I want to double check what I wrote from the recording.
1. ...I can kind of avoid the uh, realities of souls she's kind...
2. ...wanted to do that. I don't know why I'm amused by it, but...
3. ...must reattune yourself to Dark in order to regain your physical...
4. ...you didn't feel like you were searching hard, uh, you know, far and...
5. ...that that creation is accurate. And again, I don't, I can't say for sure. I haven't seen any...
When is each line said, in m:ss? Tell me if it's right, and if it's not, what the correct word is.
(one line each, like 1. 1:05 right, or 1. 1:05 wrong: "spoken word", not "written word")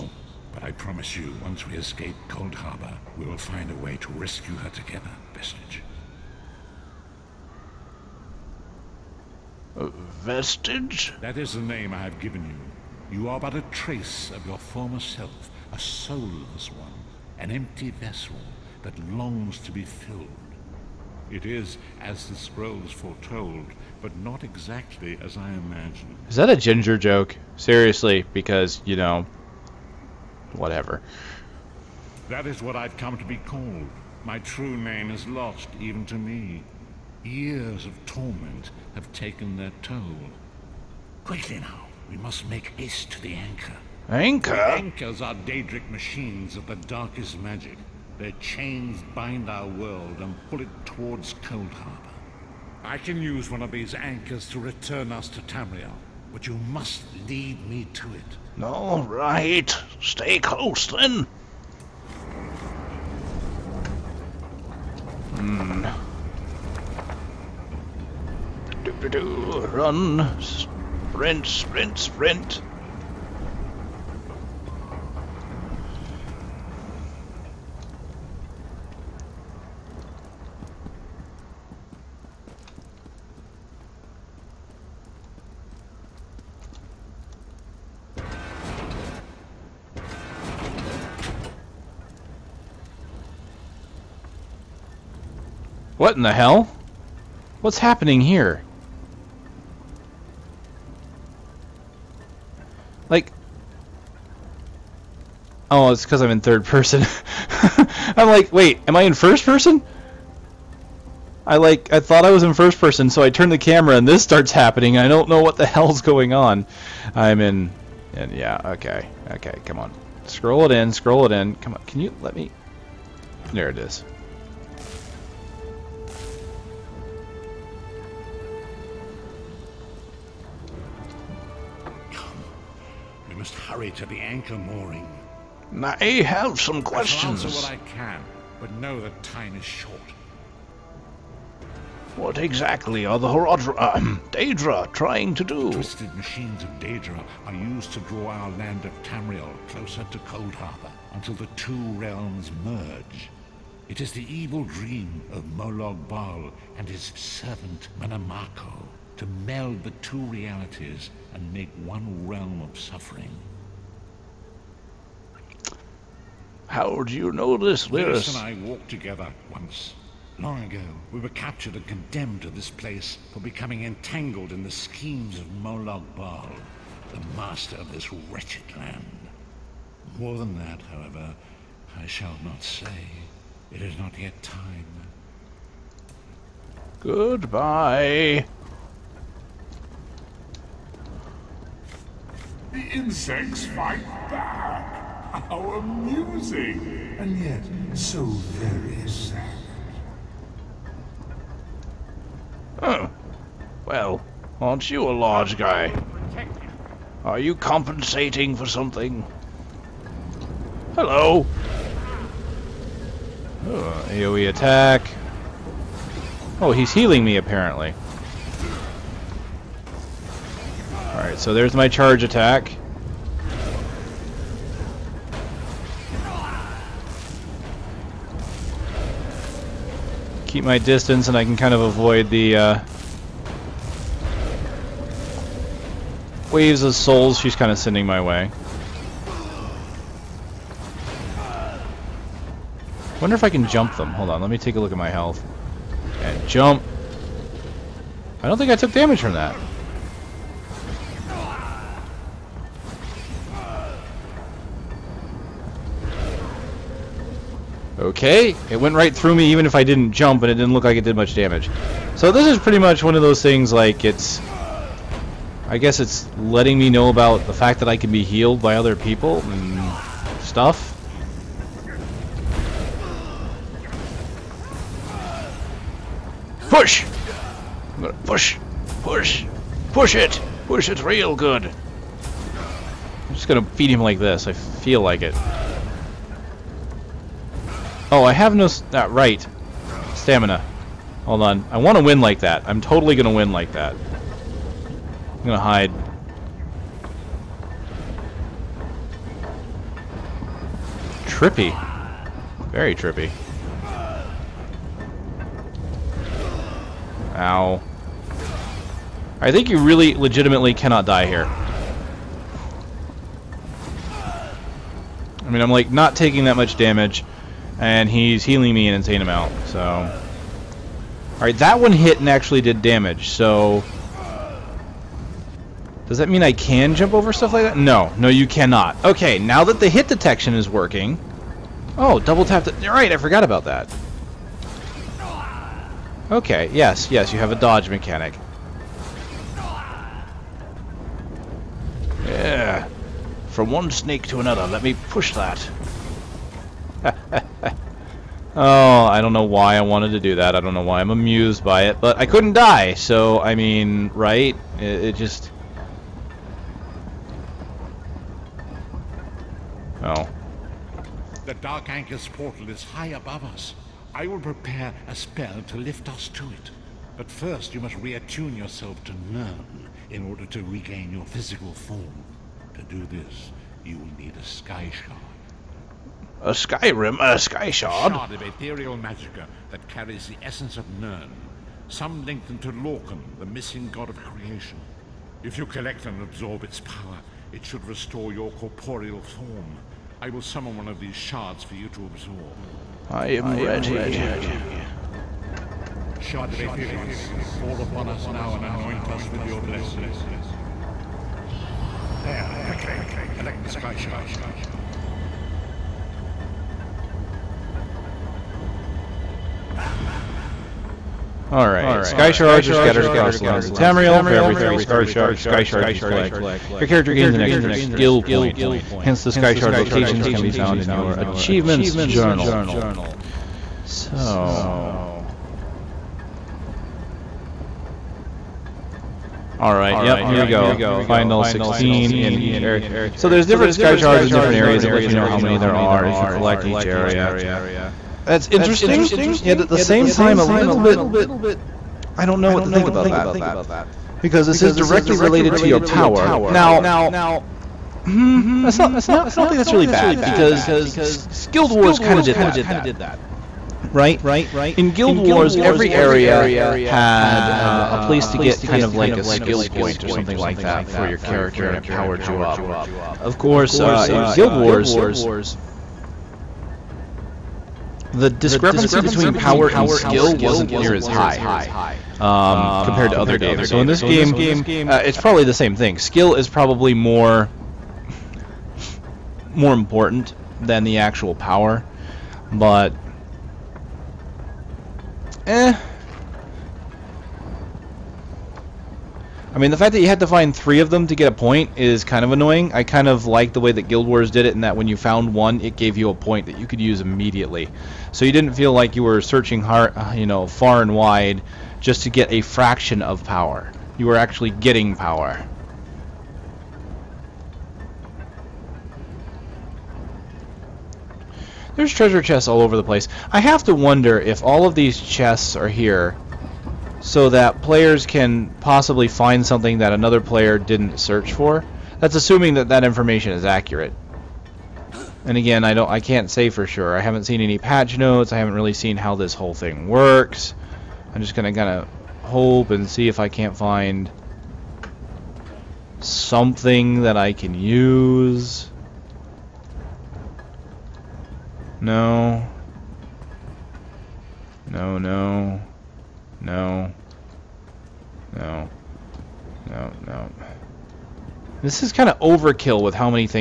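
1. 3:51 wrong: "waves", not "realities"
2. 5:49 right
3. 6:07 wrong: "Nirn", not "Dark"
4. 8:18 right
5. 8:42 wrong: "information", not "creation".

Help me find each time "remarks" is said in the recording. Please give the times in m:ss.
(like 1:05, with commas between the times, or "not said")
not said.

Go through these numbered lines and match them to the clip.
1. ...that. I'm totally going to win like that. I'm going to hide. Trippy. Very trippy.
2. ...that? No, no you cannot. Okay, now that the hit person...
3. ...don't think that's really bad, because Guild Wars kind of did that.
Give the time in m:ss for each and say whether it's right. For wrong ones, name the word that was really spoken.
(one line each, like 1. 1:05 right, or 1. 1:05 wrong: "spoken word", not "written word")
1. 4:52 right
2. 5:27 wrong: "detection", not "person"
3. 7:29 right.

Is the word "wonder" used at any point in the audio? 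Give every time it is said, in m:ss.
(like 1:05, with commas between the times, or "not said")
4:03, 8:33.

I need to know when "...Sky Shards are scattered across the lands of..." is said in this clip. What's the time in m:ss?
6:52.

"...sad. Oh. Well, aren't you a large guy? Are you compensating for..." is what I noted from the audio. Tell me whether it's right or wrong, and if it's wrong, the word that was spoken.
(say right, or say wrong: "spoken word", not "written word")
right.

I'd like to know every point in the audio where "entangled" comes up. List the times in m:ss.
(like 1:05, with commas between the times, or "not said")
2:53.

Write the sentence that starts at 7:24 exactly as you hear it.
Because this is directly related to your power.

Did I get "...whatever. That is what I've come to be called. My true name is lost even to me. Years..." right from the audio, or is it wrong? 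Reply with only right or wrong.
right.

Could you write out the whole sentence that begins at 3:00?
More than that, however, I shall not say.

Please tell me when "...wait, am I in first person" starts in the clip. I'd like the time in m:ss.
1:48.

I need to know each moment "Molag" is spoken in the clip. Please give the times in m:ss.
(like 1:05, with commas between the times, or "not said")
2:35, 2:55.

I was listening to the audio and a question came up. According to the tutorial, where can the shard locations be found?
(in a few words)
Achievements Journal.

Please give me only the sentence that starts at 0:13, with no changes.
You are but a trace of your former self, a soulless one, an empty vessel that longs to be filled.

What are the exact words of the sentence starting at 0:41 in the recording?
Quickly now, we must make haste to the anchor.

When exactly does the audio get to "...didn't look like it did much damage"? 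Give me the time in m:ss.
4:20.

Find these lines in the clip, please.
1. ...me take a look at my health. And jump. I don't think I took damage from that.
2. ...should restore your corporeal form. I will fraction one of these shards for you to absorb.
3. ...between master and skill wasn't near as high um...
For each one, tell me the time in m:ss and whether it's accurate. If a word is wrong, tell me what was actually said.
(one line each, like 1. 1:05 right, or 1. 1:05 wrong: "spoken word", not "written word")
1. 4:04 right
2. 6:27 wrong: "summon", not "fraction"
3. 7:49 wrong: "power", not "master".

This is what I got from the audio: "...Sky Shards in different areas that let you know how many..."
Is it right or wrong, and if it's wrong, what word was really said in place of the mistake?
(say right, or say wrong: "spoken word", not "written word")
right.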